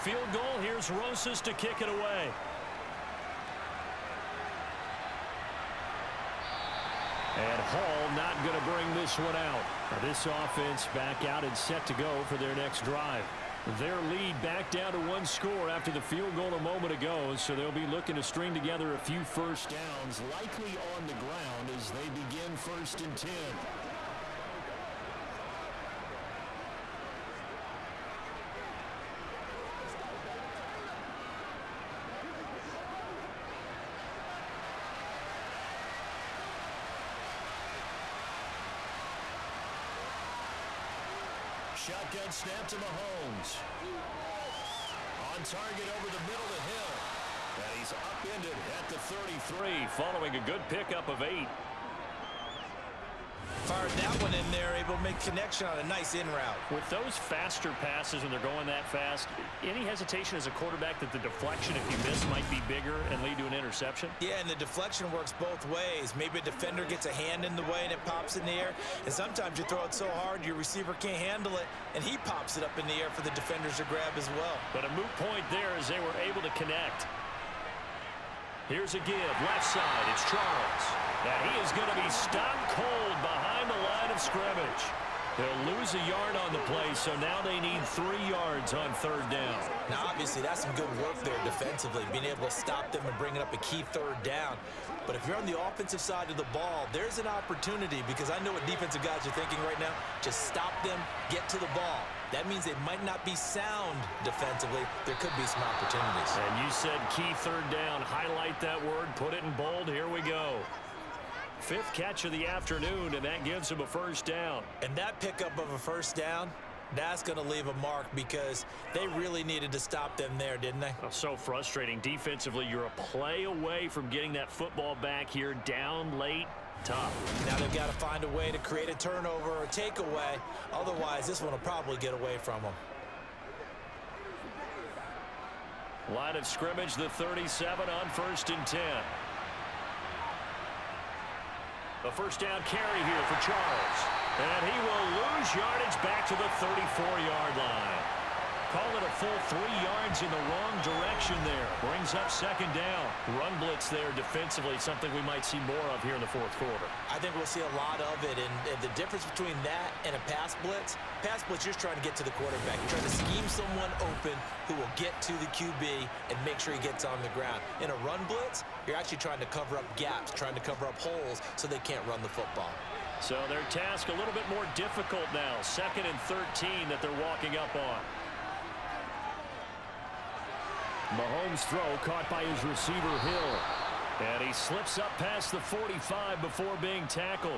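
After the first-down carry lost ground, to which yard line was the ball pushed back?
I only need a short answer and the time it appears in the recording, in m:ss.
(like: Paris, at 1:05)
34, at 2:26.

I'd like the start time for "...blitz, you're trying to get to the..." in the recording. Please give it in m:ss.
2:41.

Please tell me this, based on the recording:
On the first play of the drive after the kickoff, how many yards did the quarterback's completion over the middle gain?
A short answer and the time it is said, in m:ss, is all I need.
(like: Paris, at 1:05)
8, at 0:51.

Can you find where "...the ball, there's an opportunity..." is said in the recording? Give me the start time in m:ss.
1:36.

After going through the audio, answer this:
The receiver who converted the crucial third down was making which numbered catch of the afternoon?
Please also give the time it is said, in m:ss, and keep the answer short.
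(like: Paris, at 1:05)
Fifth, at 1:51.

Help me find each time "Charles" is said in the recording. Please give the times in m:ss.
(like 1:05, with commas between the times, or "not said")
1:20, 2:23.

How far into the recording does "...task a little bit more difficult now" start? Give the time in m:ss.
2:53.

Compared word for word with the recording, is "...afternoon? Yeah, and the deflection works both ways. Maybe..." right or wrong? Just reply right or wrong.
wrong.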